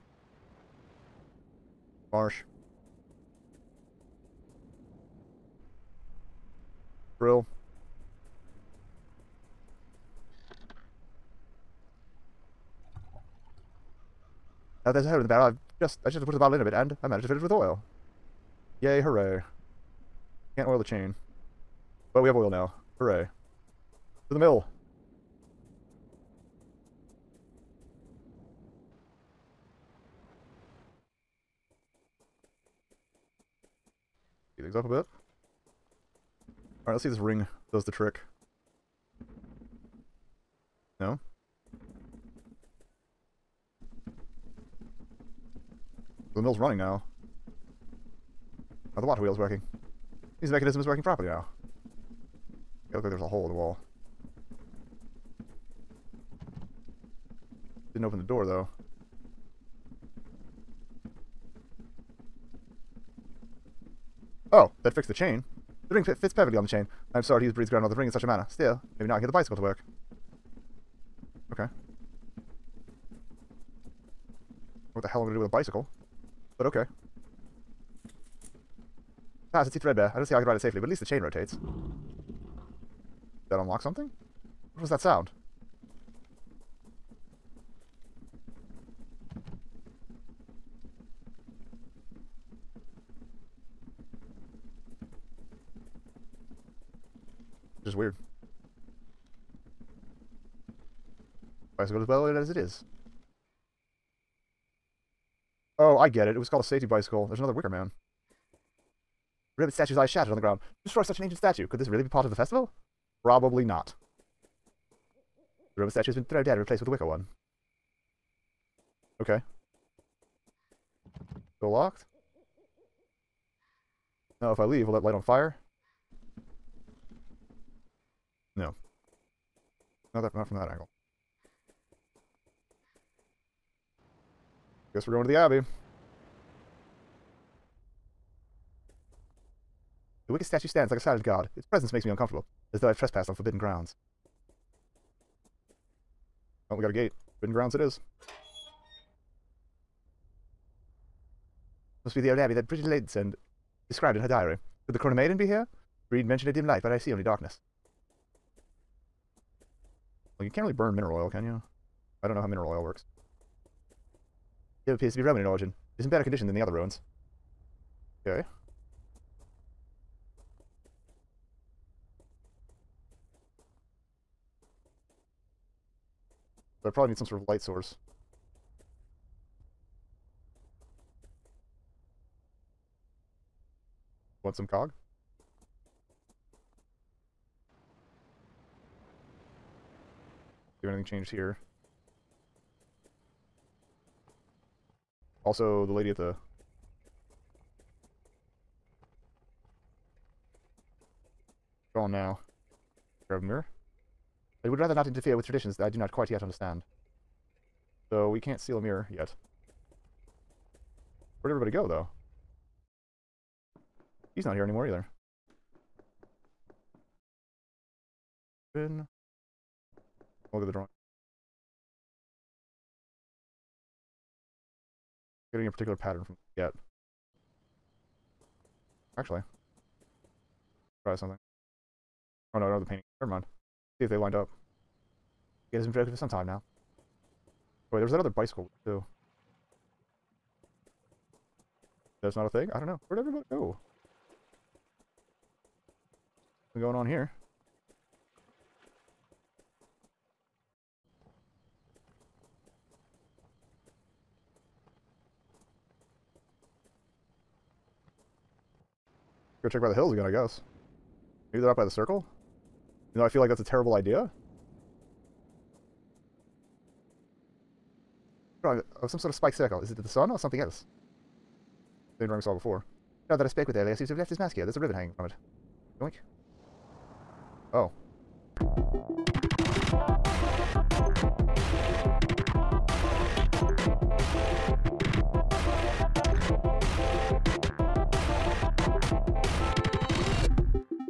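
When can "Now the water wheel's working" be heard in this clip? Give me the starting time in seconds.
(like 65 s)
48 s.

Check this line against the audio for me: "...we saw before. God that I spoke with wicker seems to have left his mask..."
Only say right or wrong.
wrong.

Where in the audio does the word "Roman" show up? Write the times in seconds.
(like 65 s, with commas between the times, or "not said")
115 s, 165 s.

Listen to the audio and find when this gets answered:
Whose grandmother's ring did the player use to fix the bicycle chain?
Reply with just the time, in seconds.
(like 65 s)
67 s.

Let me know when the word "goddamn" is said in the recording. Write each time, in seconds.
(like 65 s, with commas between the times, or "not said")
not said.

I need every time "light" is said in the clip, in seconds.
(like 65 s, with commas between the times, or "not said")
125 s, 156 s, 177 s.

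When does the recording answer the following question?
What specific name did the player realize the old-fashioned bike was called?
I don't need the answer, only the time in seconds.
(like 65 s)
106 s.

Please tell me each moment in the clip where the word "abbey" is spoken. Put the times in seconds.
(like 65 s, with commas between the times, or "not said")
135 s, 152 s.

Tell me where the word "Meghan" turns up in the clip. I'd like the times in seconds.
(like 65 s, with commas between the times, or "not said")
not said.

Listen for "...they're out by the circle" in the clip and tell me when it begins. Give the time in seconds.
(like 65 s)
261 s.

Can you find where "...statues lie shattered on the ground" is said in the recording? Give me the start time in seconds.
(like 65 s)
109 s.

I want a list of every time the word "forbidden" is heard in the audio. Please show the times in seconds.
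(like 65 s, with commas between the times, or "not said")
143 s, 147 s.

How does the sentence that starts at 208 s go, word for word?
So we can't seal a mirror yet.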